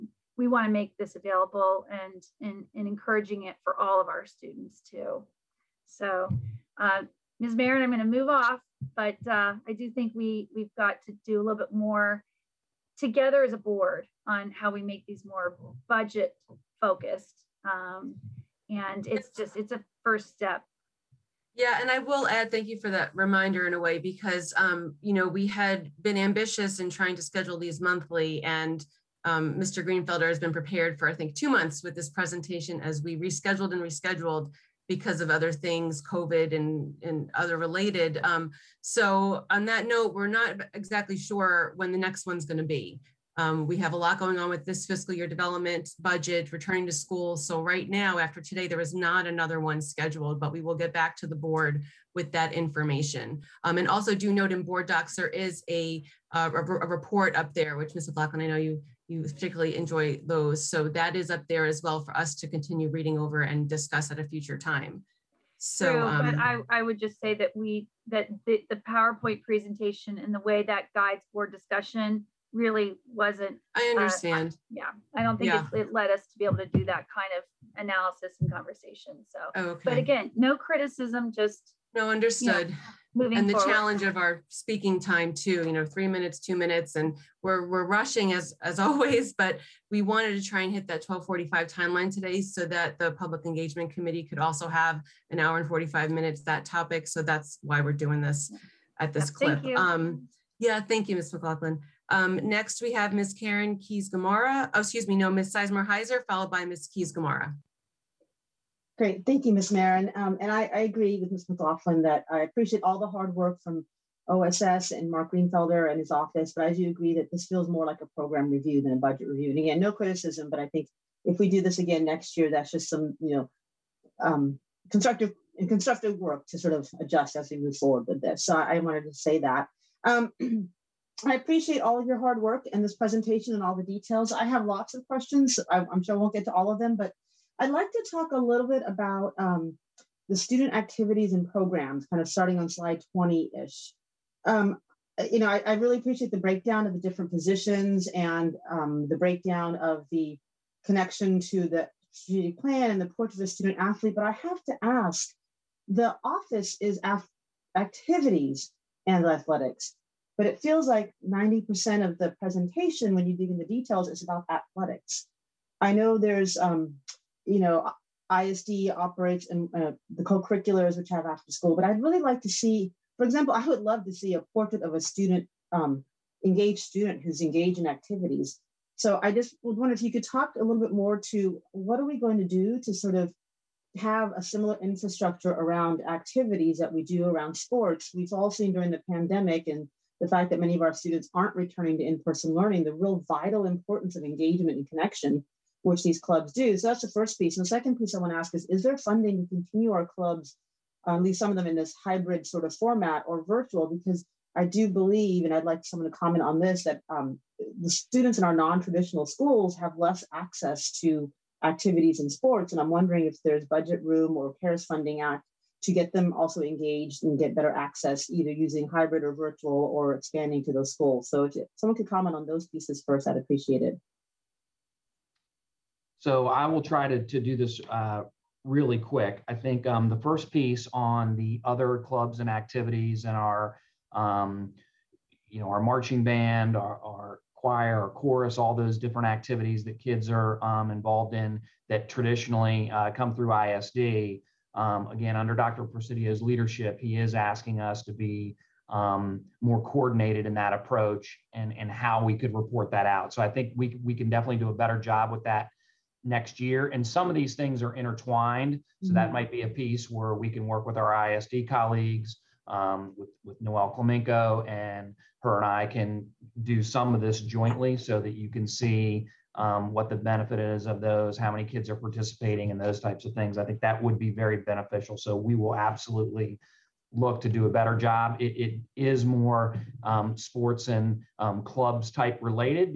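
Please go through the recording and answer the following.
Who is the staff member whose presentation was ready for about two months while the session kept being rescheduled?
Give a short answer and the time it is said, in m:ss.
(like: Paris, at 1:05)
Mr. Greenfelder, at 0:29.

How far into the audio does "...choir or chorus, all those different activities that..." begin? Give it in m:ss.
3:57.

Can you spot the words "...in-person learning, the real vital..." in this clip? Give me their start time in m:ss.
3:12.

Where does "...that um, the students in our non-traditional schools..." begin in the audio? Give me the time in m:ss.
3:26.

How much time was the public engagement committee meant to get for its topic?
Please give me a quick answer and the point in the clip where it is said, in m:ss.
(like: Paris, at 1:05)
1 hour 45 minutes, at 1:35.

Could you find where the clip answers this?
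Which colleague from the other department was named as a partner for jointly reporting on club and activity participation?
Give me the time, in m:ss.
4:23.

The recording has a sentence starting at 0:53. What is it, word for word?
Um, and also do note in board docs, there is a, uh, a, a, report up there, which Ms.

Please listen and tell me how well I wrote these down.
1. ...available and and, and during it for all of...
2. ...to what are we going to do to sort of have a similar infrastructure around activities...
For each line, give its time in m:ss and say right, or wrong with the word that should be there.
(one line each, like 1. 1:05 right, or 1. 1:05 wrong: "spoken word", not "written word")
1. 0:01 wrong: "encouraging", not "during"
2. 3:01 right.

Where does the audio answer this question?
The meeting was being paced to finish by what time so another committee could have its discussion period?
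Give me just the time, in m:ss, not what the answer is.
1:31.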